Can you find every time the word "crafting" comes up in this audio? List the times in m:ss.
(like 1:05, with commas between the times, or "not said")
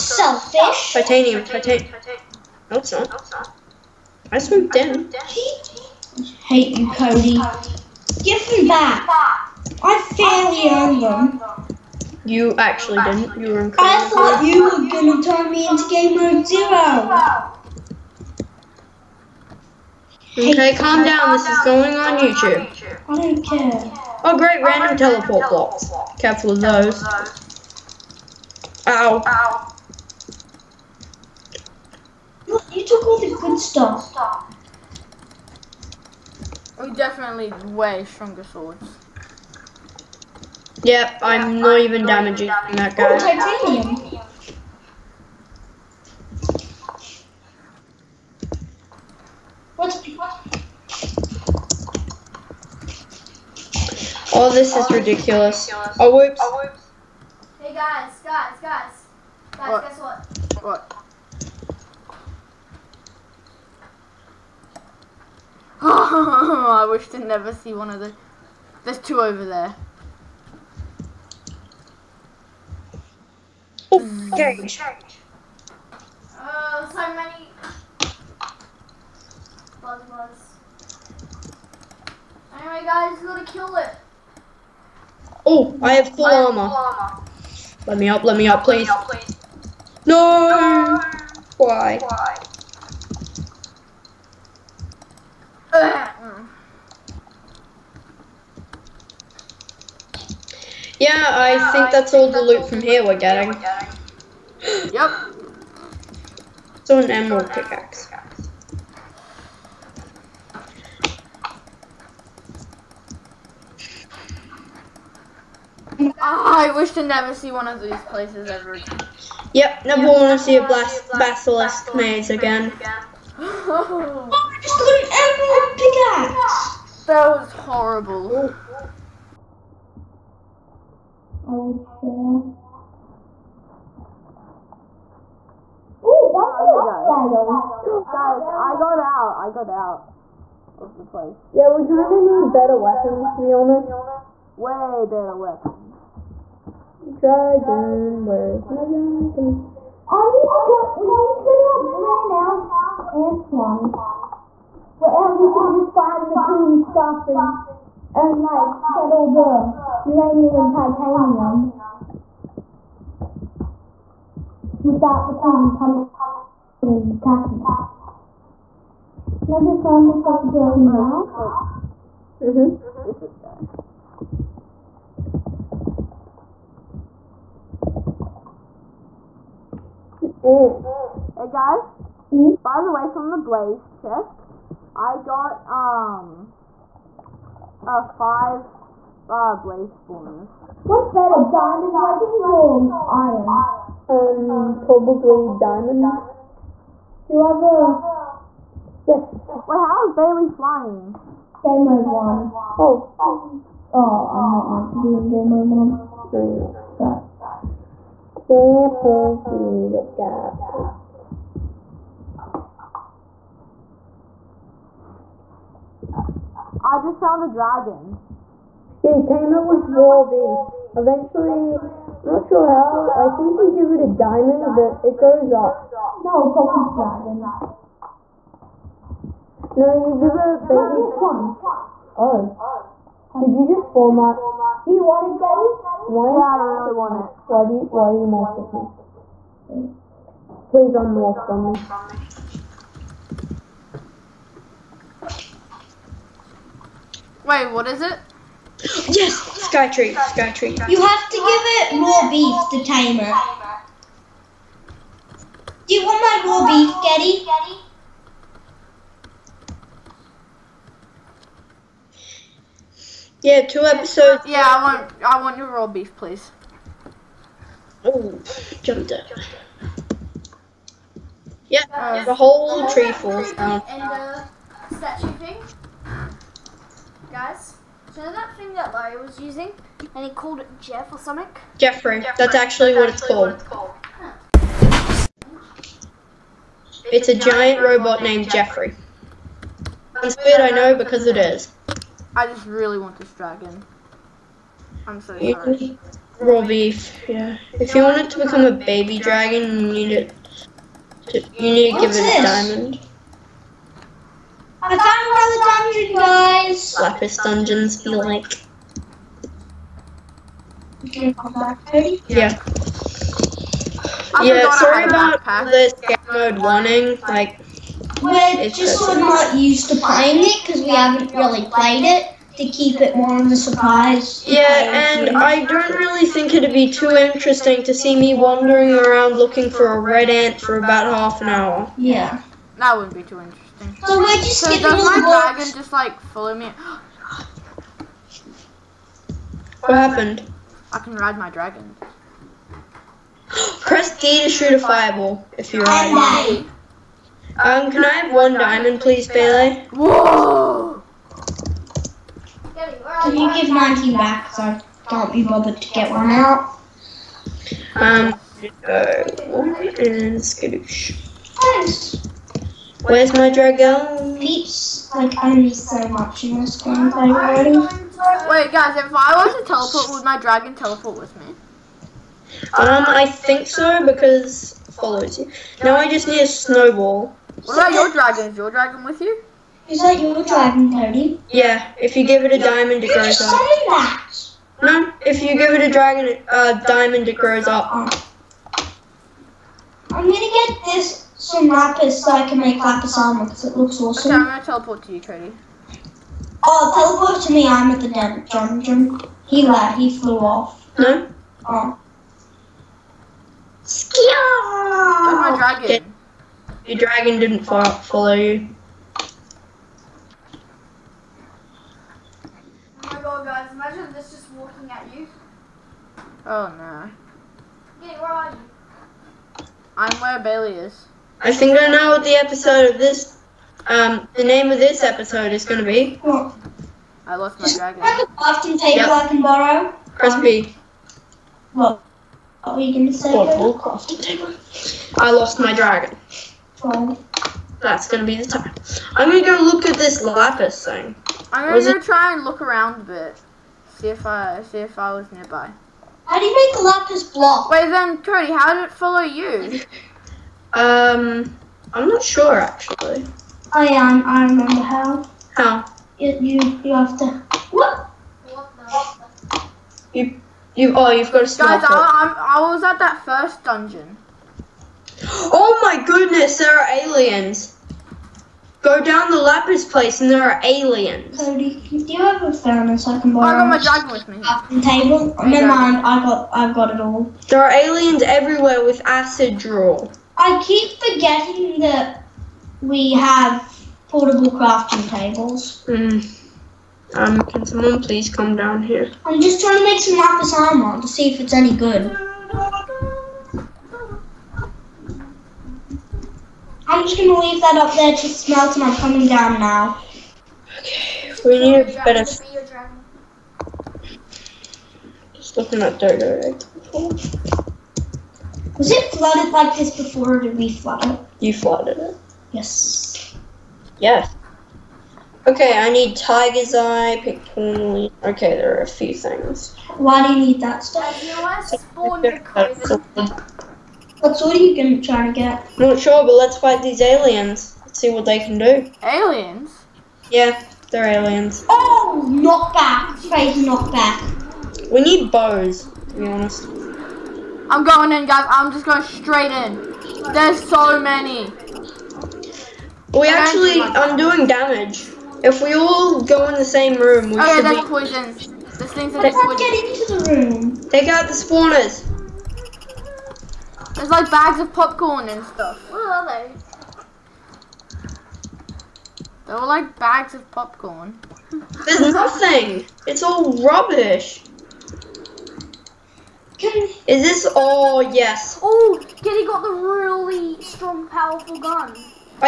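7:54, 8:04.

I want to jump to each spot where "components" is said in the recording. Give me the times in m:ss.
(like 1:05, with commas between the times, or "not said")
not said.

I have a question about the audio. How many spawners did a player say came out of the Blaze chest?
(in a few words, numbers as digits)
5.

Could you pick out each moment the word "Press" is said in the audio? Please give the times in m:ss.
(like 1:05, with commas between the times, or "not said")
5:43, 7:10.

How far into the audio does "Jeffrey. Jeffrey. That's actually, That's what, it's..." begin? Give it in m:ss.
4:41.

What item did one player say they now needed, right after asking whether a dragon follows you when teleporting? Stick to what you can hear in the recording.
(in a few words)
A snowball.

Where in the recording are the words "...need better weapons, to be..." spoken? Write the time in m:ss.
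2:22.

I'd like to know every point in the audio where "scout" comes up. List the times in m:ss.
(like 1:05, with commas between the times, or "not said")
5:15.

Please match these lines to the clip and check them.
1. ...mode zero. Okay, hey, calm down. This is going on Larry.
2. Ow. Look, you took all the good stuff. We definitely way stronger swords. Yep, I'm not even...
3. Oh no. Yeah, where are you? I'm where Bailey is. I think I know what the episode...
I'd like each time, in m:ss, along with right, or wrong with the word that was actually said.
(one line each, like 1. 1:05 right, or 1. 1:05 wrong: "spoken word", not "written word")
1. 0:16 wrong: "YouTube", not "Larry"
2. 0:29 right
3. 6:56 right.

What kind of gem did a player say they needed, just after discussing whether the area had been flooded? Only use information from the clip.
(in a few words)
Tiger's eye.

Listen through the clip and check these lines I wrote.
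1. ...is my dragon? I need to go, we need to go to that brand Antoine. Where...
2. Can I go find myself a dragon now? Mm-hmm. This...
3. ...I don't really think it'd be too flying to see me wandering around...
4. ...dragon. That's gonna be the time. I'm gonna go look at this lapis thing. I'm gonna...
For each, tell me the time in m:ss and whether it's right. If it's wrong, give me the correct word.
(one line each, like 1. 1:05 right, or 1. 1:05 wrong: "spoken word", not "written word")
1. 2:28 right
2. 2:49 right
3. 5:25 wrong: "interesting", not "flying"
4. 7:15 right.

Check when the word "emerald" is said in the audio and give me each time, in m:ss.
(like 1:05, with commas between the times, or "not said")
1:47, 2:06.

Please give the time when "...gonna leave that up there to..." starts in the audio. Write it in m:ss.
8:17.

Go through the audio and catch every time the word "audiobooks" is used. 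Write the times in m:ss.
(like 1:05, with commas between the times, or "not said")
not said.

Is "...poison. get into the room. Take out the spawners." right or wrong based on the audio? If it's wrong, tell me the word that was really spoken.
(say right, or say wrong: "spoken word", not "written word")
right.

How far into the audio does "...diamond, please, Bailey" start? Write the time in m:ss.
5:48.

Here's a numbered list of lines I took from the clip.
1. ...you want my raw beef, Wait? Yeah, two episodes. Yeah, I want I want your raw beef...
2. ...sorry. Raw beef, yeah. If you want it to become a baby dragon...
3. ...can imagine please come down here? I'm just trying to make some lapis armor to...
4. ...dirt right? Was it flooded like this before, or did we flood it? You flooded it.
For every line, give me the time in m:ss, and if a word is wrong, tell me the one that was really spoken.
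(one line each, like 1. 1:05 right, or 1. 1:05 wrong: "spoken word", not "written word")
1. 4:15 wrong: "Geddy", not "Wait"
2. 4:55 right
3. 8:07 wrong: "someone", not "imagine"
4. 8:25 right.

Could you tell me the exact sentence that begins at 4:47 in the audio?
It's, it's a, a giant, giant robot, robot named Jeffrey.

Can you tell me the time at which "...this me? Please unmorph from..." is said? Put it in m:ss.
3:58.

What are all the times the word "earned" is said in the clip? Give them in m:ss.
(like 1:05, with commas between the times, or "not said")
0:10.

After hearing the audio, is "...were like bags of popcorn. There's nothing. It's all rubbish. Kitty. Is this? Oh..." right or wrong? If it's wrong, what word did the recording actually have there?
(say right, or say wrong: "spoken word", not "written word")
right.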